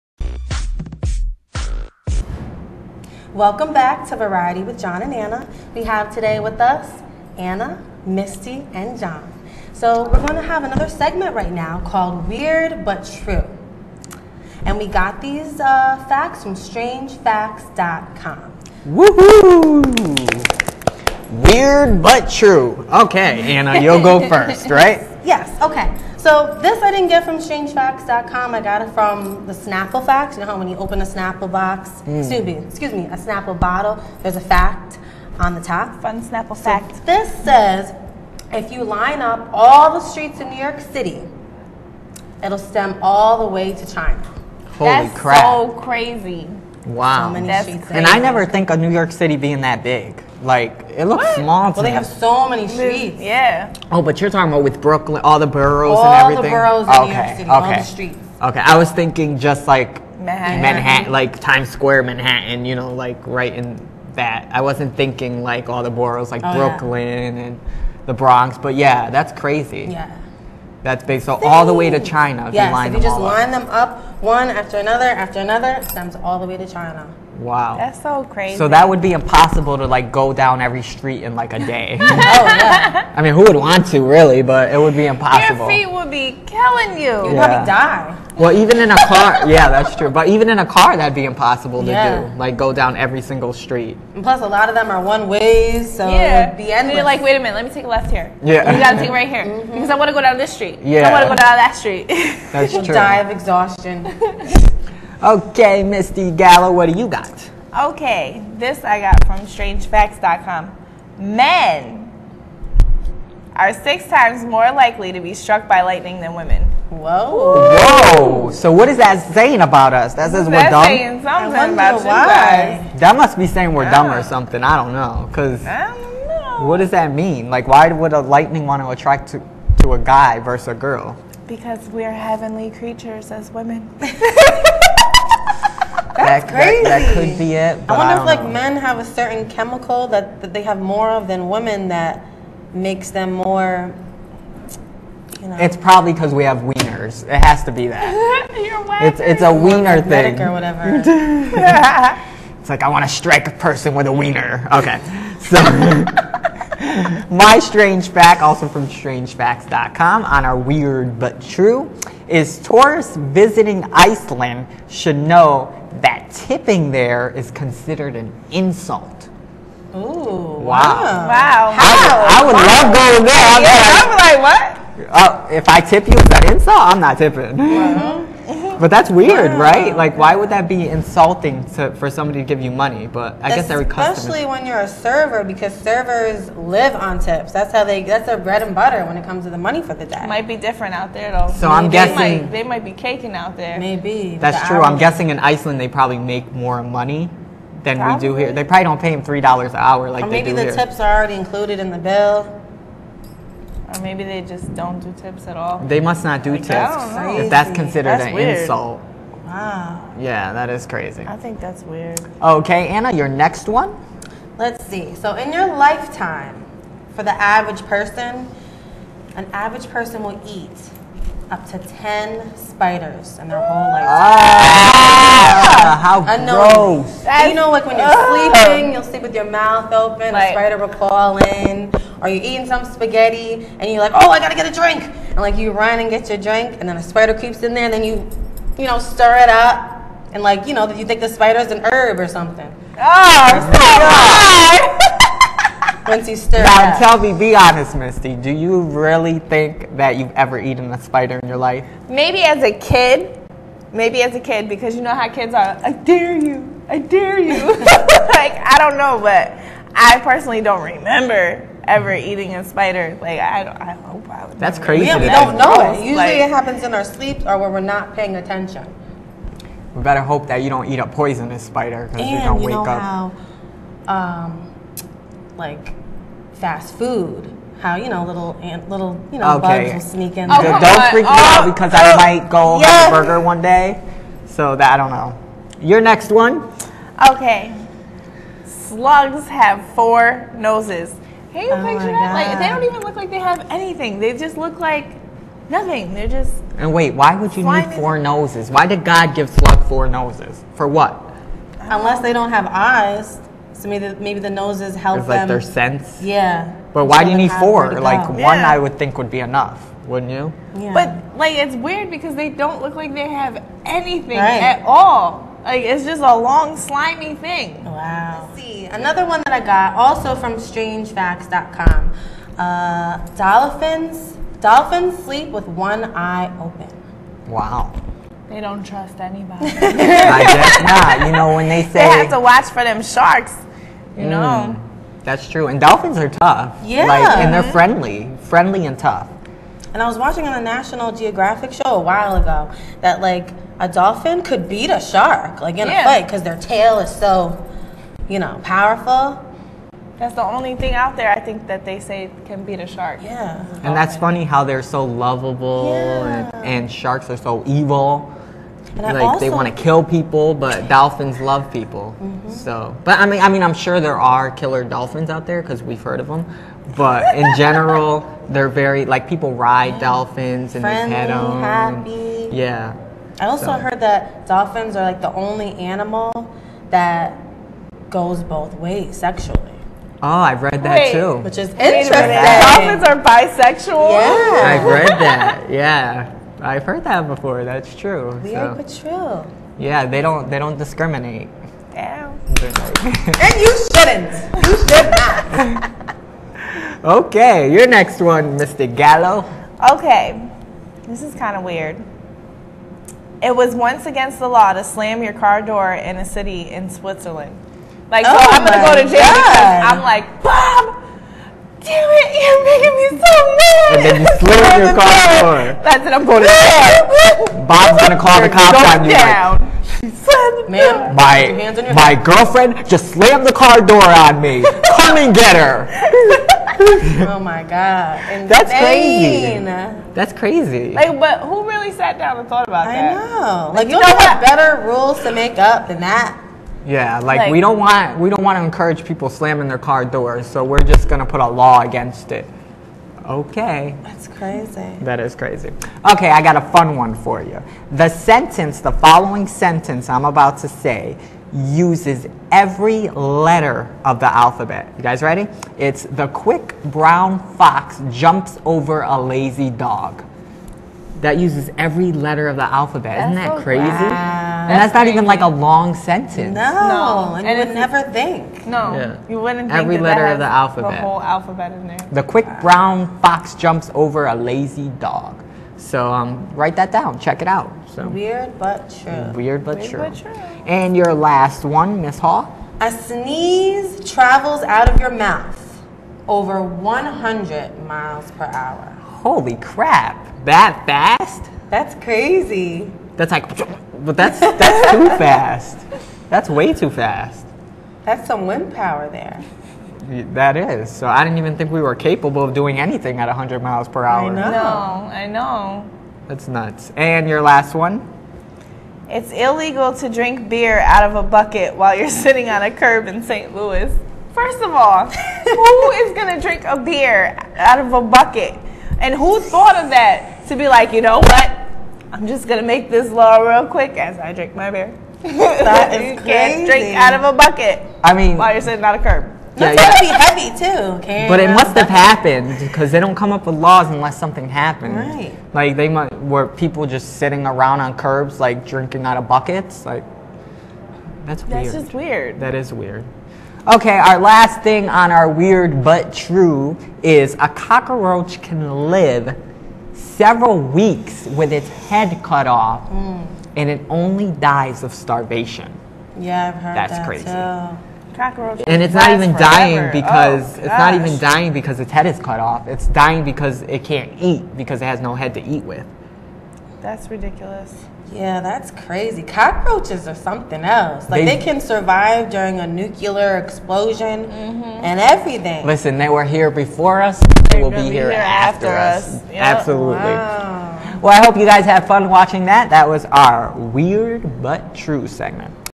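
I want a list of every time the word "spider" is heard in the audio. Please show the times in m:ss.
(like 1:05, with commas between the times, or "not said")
3:42, 3:50, 3:57, 4:01, 4:11, 4:22, 4:31.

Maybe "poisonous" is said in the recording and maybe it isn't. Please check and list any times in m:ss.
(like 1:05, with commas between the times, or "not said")
4:31.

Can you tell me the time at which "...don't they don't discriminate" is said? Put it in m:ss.
6:30.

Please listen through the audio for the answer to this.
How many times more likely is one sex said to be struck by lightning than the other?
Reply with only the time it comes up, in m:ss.
1:53.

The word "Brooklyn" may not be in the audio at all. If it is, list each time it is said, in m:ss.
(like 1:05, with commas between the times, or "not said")
0:54, 1:06.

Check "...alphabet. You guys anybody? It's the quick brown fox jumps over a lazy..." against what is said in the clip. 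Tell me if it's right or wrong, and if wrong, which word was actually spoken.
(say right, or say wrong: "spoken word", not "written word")
wrong: "ready", not "anybody".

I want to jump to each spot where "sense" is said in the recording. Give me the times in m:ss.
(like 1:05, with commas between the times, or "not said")
5:05.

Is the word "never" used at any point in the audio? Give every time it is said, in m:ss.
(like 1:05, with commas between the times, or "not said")
0:48, 7:47.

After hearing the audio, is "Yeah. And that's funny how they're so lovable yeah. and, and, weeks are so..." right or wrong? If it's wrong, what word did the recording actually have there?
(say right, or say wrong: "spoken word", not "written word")
wrong: "sharks", not "weeks".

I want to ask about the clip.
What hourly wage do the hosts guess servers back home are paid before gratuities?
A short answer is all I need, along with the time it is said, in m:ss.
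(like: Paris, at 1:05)
3 dollars, at 3:19.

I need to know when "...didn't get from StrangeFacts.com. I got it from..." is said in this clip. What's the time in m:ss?
0:26.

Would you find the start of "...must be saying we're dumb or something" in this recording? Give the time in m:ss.
2:03.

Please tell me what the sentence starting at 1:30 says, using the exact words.
But even in a car, that'd be impossible to yeah.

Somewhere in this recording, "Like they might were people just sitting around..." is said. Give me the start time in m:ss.
8:55.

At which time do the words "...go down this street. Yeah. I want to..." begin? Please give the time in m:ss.
1:40.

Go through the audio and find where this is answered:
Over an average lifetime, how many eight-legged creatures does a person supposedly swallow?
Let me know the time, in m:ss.
3:41.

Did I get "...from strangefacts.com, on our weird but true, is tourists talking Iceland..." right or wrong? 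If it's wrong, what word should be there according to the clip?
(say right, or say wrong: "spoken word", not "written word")
wrong: "visiting", not "talking".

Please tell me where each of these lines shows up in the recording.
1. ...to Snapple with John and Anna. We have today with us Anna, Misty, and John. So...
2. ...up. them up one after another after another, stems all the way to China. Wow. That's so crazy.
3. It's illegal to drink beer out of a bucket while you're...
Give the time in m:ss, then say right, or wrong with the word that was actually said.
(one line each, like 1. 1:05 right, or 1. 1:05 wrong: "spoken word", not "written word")
1. 0:04 wrong: "Variety", not "Snapple"
2. 1:13 right
3. 8:29 right.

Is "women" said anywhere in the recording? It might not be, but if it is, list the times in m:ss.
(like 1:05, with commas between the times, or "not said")
1:56, 2:13, 2:21.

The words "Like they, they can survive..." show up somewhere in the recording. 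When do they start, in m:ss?
9:31.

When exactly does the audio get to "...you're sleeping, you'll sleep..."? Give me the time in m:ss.
3:47.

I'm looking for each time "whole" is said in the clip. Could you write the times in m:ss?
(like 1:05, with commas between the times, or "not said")
3:43, 7:51.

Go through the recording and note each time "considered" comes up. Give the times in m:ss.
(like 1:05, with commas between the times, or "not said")
2:47, 3:27.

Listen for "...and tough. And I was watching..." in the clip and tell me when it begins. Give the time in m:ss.
5:38.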